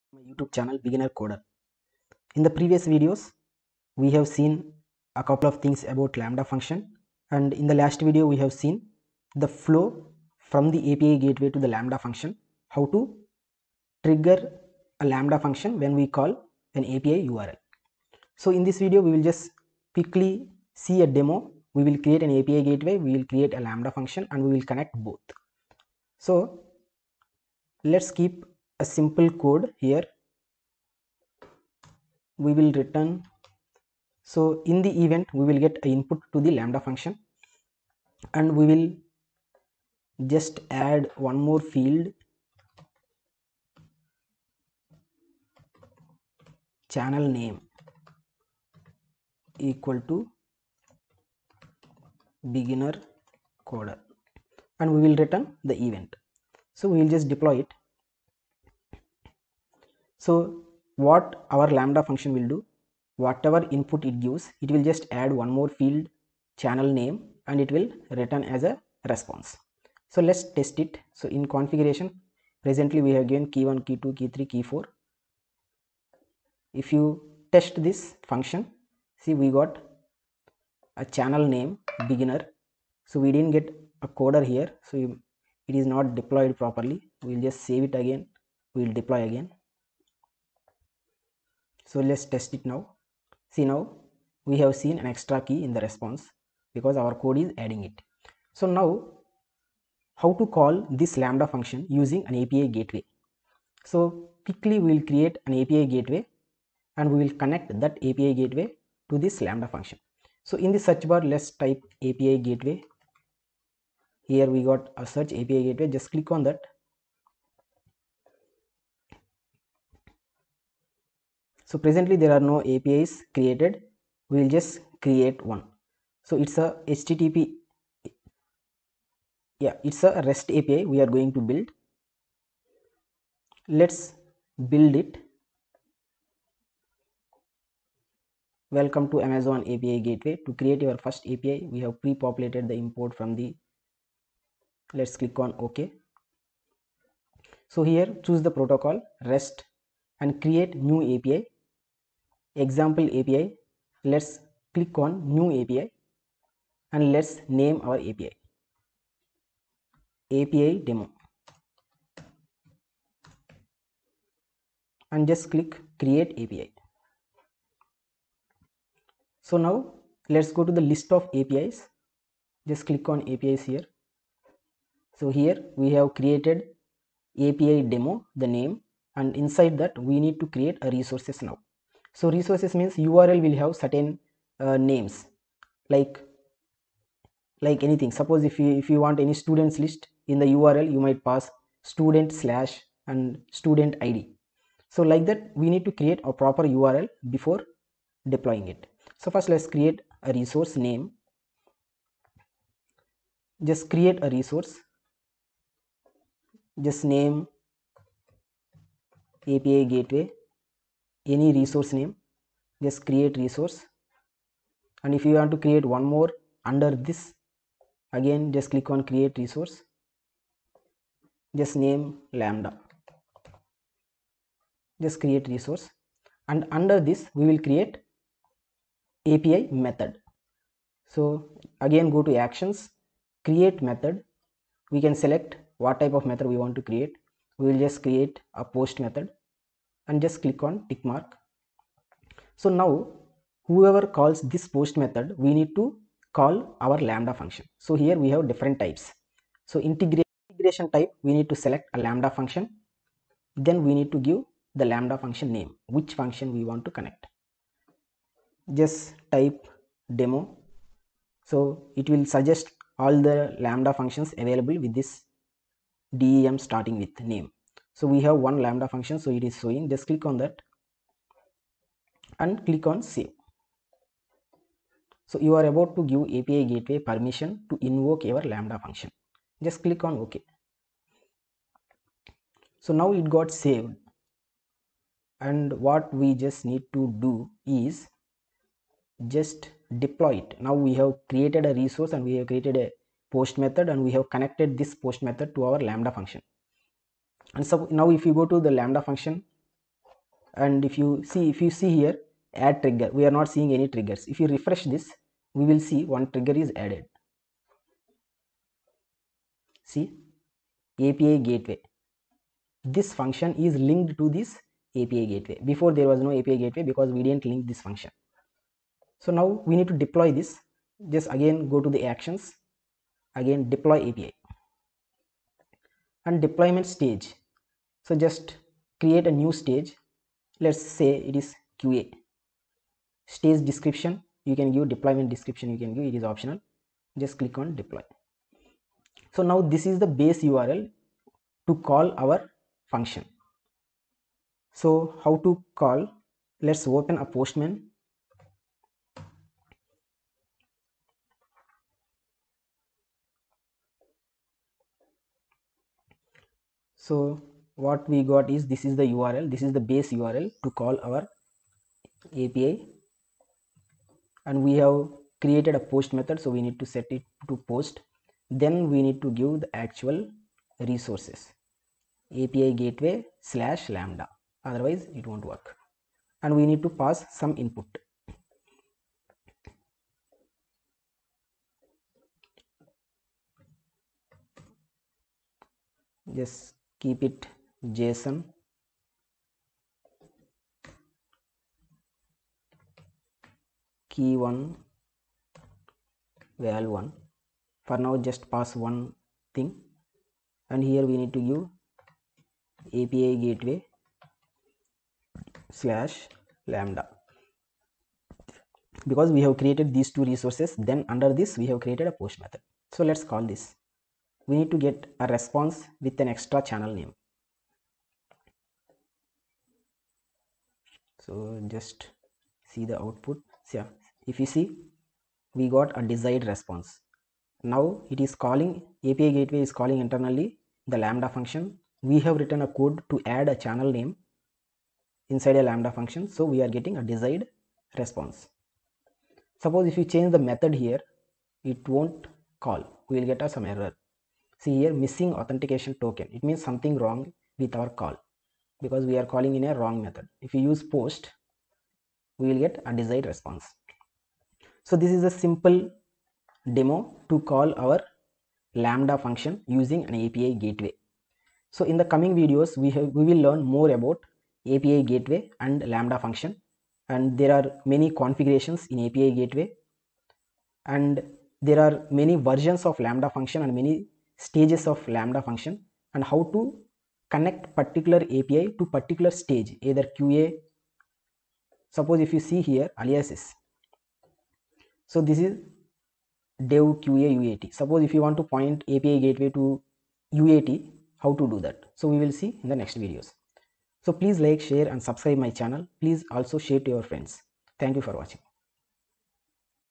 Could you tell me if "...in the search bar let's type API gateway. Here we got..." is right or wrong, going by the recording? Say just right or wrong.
right.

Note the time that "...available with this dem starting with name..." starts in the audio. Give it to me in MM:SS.
04:24.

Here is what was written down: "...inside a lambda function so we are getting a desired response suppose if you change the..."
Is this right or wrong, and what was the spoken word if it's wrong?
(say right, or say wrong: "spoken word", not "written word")
right.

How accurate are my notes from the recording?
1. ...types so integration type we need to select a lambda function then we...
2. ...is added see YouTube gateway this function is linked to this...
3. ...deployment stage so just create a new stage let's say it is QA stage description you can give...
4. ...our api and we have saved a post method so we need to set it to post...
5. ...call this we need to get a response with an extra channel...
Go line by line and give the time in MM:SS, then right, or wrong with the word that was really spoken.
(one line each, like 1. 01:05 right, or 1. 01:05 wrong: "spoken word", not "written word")
1. 04:08 right
2. 05:06 wrong: "API", not "YouTube"
3. 05:26 right
4. 06:01 wrong: "created", not "saved"
5. 06:53 right.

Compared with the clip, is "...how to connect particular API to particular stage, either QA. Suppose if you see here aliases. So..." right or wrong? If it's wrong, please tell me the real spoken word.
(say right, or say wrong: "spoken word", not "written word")
right.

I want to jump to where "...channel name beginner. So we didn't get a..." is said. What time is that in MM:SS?
01:21.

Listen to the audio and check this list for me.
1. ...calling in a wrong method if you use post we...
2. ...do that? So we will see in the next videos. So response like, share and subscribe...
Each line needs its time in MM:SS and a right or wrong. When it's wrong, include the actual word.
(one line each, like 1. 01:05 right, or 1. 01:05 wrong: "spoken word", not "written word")
1. 07:29 right
2. 08:11 wrong: "please", not "response".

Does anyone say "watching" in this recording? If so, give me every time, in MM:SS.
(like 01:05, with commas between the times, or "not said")
08:18.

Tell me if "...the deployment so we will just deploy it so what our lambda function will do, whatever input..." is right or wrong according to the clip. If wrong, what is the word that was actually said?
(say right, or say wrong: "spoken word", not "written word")
wrong: "event", not "deployment".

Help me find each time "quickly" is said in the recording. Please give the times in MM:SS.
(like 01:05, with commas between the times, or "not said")
00:19, 01:44.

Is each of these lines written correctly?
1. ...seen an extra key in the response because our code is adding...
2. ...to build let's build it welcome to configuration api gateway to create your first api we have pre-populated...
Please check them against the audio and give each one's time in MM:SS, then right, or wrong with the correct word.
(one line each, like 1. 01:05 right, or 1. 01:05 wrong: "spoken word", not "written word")
1. 01:34 right
2. 02:11 wrong: "amazon", not "configuration".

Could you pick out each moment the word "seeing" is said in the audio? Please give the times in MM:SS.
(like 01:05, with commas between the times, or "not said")
05:03.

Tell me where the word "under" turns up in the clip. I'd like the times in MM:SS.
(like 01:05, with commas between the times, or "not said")
03:36, 03:46, 06:51.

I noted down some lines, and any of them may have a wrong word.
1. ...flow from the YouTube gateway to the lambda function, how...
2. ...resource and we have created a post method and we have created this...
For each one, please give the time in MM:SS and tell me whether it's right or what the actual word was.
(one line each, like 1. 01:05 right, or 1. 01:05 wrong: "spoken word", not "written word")
1. 00:09 wrong: "API", not "YouTube"
2. 04:51 wrong: "connected", not "created".